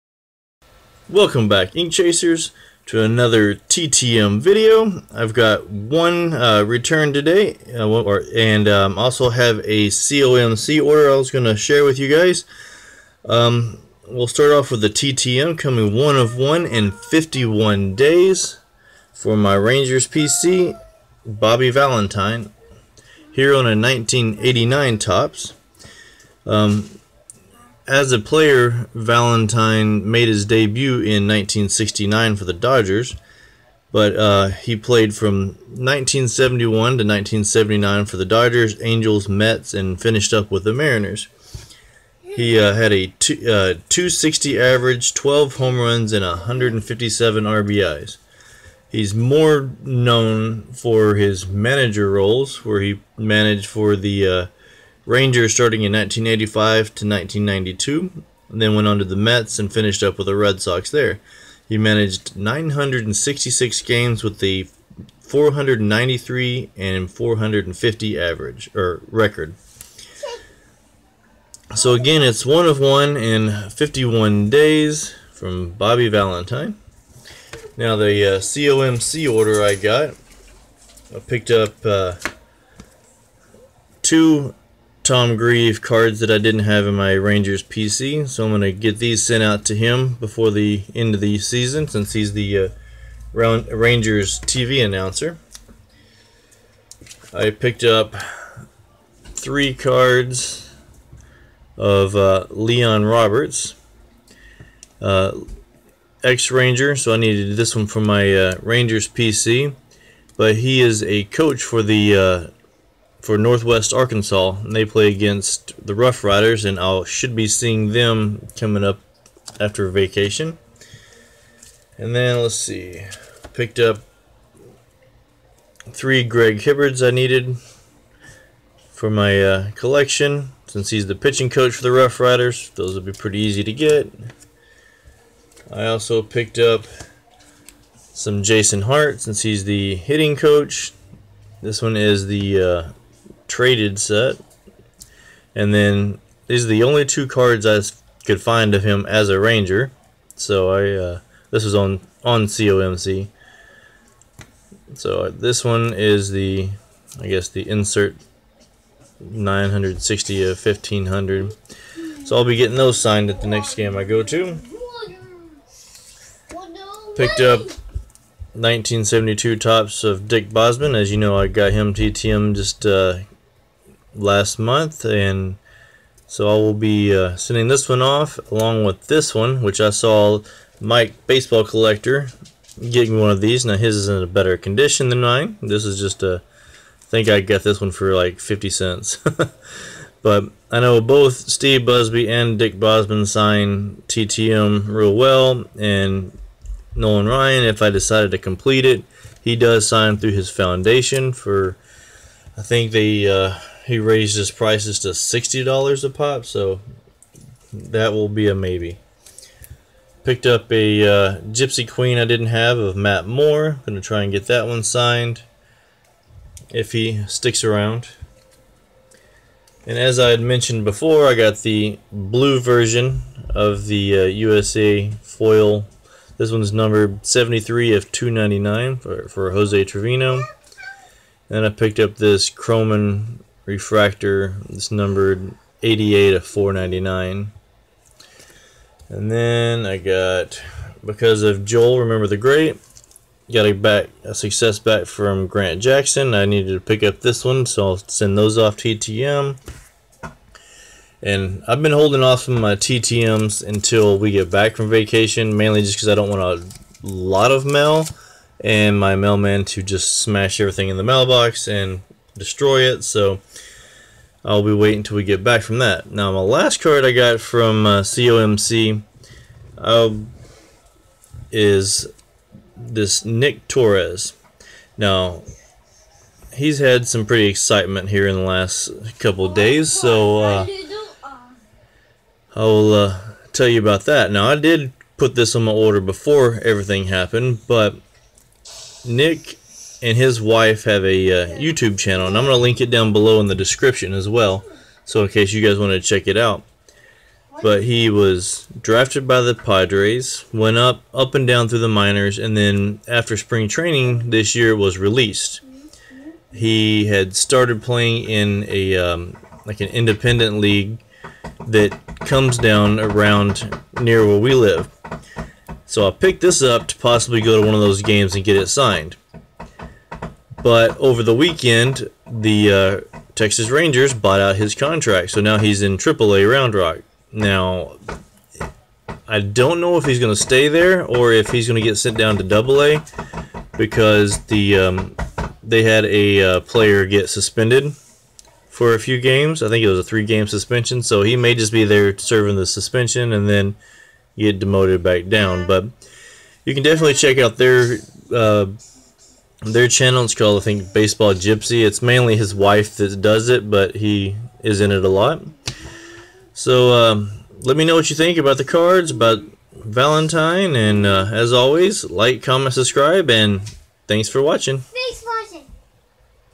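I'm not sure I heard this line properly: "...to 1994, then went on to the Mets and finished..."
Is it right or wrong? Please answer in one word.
wrong.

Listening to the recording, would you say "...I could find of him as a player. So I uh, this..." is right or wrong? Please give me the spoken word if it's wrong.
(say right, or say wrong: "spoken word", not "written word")
wrong: "ranger", not "player".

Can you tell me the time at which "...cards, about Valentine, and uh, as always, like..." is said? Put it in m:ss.
5:58.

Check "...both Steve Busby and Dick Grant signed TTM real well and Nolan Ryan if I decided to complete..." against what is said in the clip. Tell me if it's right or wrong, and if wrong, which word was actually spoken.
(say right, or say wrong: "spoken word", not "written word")
wrong: "Bosman", not "Grant".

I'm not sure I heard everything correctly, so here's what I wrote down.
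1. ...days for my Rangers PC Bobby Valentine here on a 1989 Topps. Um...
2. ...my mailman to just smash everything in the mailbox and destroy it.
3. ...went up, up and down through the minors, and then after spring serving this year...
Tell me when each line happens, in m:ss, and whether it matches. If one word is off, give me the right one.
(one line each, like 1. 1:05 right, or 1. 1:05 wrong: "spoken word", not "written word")
1. 0:17 right
2. 4:18 right
3. 5:00 wrong: "training", not "serving".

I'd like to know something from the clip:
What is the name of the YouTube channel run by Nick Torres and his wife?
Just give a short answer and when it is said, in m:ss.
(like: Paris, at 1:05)
Baseball Gypsy, at 5:50.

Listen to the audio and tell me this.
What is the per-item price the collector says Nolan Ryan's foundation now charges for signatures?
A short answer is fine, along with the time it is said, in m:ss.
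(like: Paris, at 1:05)
$60, at 3:25.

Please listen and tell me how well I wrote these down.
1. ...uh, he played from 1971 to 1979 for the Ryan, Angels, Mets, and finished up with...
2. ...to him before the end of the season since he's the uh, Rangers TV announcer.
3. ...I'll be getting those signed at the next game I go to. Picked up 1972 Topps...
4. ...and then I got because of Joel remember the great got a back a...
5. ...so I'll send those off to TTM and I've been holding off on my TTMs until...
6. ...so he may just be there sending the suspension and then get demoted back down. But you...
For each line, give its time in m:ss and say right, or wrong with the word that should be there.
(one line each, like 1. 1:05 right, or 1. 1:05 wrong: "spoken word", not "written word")
1. 0:34 wrong: "Dodgers", not "Ryan"
2. 1:29 right
3. 2:42 right
4. 3:59 right
5. 4:07 right
6. 5:41 wrong: "serving", not "sending".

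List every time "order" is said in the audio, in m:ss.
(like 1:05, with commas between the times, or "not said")
0:10, 1:19, 4:45.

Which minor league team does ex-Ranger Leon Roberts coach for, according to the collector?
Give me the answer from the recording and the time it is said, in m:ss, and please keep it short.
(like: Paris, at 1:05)
Northwest Arkansas, at 1:53.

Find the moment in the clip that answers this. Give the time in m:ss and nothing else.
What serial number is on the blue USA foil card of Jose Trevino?
3:47.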